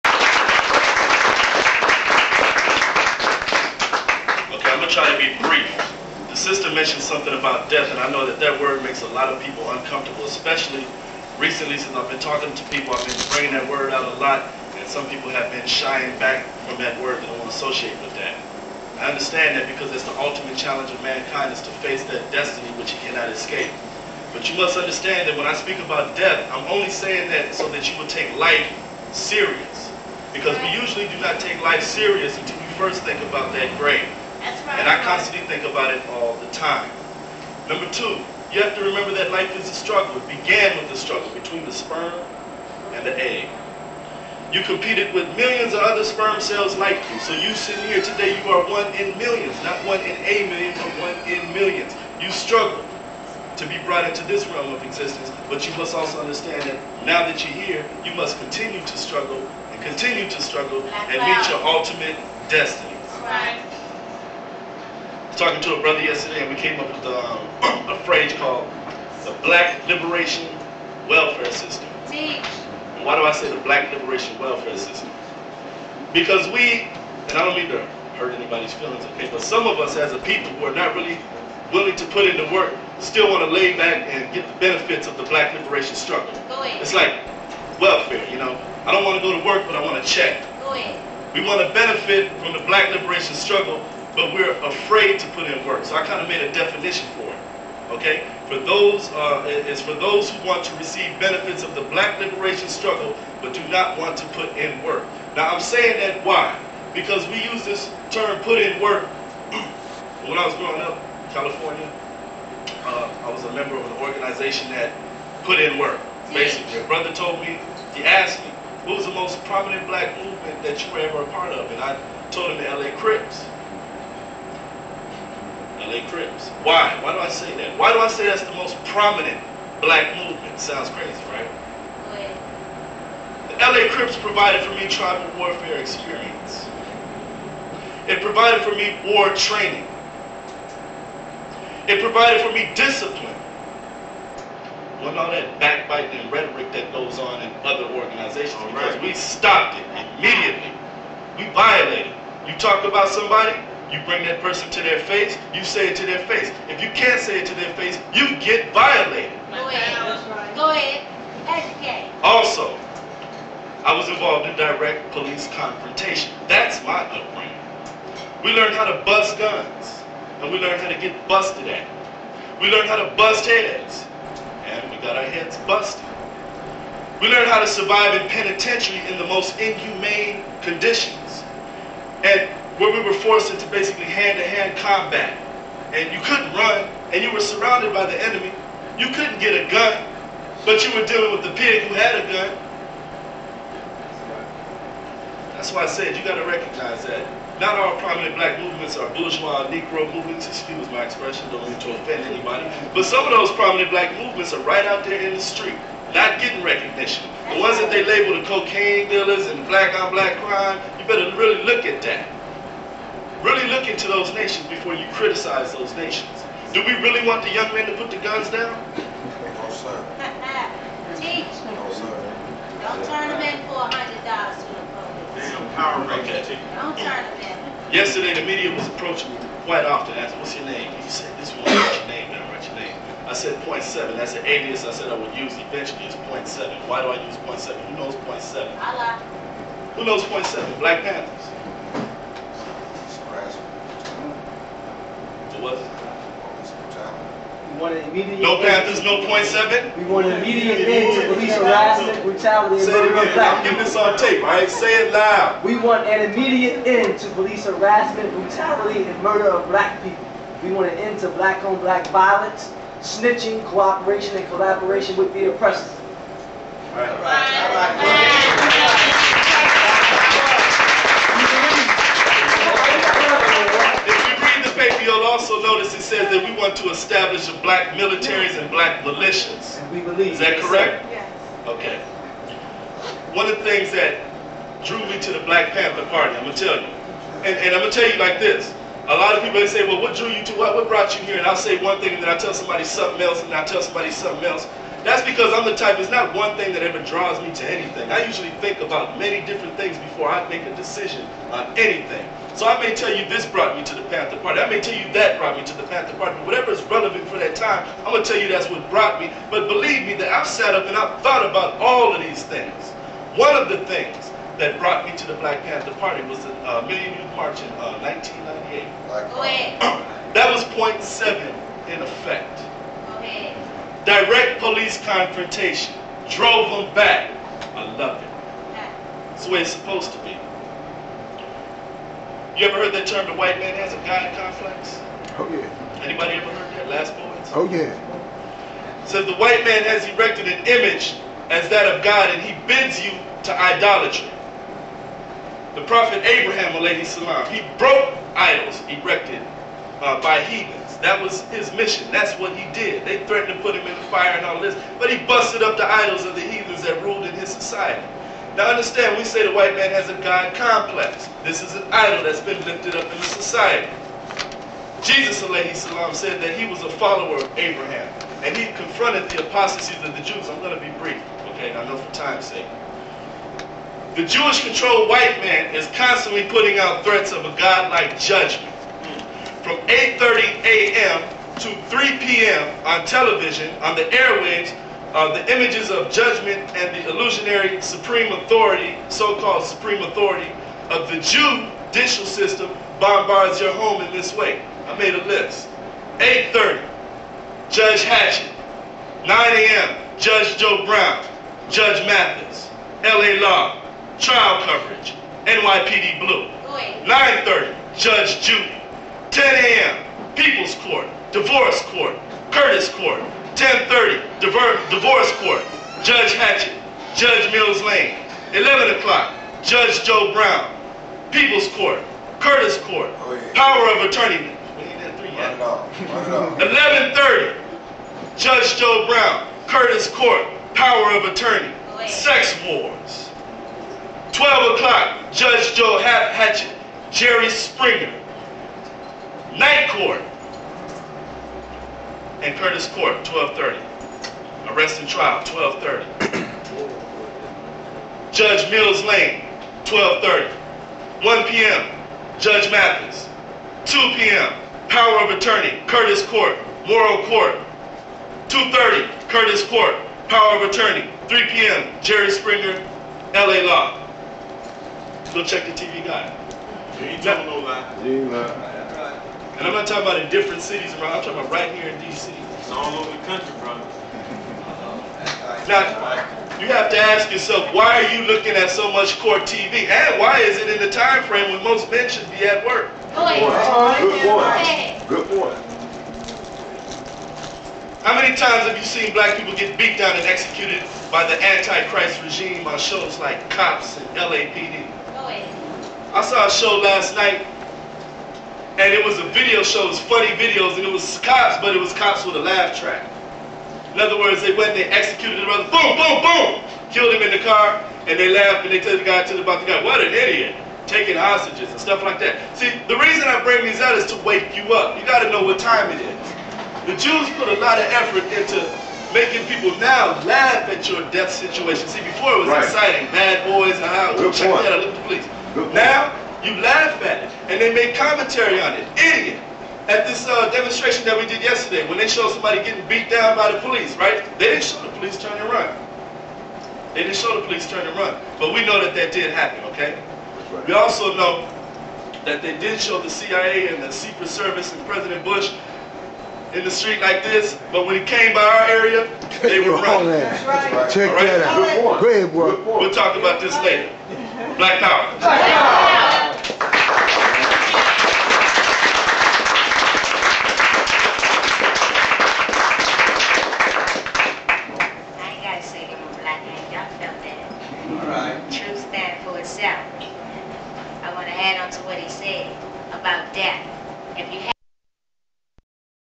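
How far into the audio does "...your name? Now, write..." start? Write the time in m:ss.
3:51.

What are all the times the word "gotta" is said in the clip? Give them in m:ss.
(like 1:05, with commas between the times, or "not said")
8:35.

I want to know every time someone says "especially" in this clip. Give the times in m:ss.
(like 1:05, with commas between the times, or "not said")
0:10.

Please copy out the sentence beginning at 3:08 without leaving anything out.
You couldn't get a gun, but you were dealing with the pig who had a gun.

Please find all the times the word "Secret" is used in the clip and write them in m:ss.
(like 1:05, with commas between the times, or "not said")
9:03.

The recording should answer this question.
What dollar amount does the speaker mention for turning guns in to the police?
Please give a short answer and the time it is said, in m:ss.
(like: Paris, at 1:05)
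$100, at 3:43.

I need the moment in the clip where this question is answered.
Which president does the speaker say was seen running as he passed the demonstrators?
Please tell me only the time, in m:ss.
9:04.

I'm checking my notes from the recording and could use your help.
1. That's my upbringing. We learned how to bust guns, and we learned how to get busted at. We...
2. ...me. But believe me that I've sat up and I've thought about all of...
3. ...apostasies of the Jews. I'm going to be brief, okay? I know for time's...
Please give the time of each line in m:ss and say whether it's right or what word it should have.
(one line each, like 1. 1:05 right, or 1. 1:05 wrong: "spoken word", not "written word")
1. 2:46 right
2. 5:09 right
3. 6:09 right.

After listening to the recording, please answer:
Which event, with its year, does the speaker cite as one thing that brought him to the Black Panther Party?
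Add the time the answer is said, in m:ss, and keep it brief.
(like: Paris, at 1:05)
Million Youth March, 1998, at 5:16.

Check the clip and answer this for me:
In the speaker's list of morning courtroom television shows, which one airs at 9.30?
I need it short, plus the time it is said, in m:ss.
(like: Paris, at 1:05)
Judge Judy, at 6:47.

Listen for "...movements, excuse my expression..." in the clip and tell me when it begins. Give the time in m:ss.
3:20.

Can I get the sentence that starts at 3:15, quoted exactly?
That's why I said you got to recognize that.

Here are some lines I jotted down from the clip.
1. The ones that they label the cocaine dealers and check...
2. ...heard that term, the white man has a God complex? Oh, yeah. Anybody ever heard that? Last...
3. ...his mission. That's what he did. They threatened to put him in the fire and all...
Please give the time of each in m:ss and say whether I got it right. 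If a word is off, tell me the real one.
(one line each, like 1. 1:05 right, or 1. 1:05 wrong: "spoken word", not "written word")
1. 3:27 wrong: "black", not "check"
2. 5:32 right
3. 5:51 right.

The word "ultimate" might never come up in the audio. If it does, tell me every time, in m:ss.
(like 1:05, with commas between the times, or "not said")
0:20, 1:01.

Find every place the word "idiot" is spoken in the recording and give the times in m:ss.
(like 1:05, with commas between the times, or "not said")
8:30, 8:48.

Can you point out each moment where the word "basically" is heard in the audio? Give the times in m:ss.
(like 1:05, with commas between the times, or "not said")
1:56, 3:03.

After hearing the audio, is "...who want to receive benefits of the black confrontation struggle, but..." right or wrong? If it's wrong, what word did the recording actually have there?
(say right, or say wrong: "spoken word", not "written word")
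wrong: "liberation", not "confrontation".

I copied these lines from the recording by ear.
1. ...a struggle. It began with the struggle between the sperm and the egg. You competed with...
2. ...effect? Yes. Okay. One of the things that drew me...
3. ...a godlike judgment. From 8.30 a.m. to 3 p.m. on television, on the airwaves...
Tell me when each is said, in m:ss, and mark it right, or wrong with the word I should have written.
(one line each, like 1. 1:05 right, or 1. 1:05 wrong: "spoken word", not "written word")
1. 0:39 right
2. 4:40 wrong: "correct", not "effect"
3. 6:17 right.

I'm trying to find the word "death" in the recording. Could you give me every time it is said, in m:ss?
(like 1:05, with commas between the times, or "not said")
0:07, 0:26, 8:41.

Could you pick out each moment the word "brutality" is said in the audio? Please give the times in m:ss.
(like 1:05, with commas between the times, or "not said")
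4:12, 4:18.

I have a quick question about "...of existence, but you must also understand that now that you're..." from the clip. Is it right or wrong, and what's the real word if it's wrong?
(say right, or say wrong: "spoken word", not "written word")
right.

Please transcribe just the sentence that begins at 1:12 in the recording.
And why do I say the Black Liberation Welfare System?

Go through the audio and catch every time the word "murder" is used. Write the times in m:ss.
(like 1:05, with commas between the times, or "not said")
4:12, 4:19.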